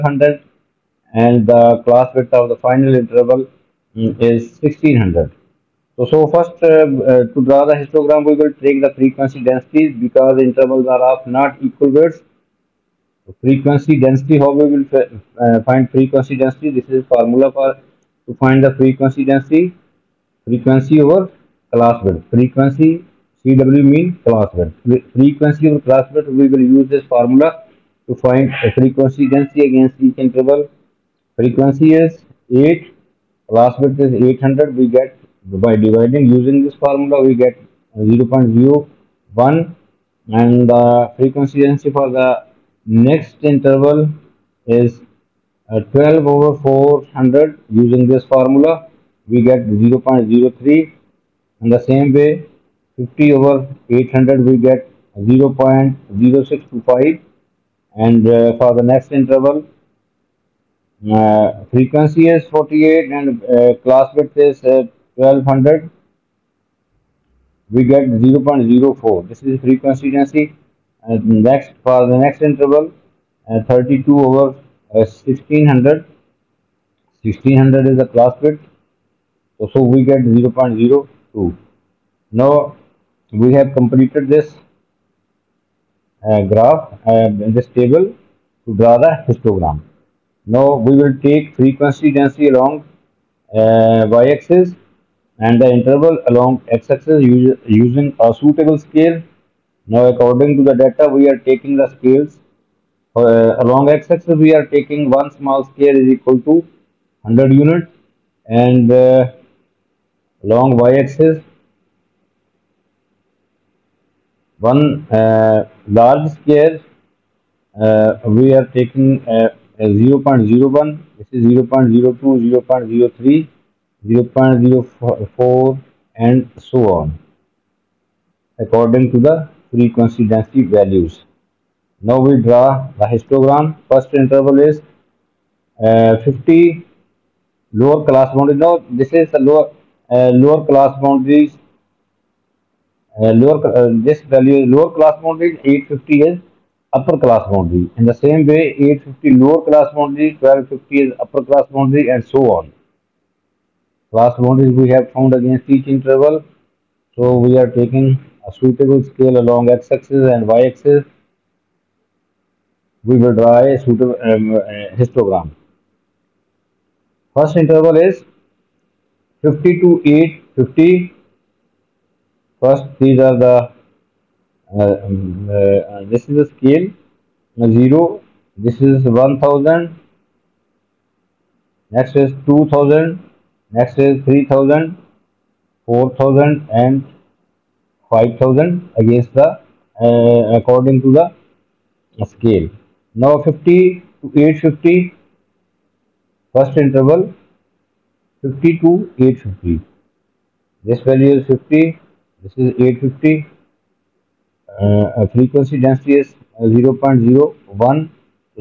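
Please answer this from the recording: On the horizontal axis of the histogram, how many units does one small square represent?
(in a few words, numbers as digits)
100.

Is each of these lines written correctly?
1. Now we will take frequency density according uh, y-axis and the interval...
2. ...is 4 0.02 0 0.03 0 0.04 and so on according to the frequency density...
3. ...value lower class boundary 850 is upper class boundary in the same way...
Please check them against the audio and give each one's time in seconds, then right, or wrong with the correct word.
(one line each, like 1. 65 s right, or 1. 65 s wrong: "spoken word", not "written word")
1. 90 s wrong: "along", not "according"
2. 121 s wrong: "0", not "4"
3. 144 s right.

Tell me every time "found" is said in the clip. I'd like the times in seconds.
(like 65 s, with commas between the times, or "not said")
155 s.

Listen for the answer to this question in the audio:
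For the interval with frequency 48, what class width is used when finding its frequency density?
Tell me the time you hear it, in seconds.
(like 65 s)
63 s.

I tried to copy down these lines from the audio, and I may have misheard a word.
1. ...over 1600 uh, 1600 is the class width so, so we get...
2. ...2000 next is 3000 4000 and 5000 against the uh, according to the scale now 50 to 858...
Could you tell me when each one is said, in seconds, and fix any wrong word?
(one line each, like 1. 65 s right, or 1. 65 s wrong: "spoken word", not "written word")
1. 74 s right
2. 182 s wrong: "850", not "858".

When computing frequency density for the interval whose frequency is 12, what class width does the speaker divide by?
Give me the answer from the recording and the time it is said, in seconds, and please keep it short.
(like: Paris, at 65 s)
400, at 45 s.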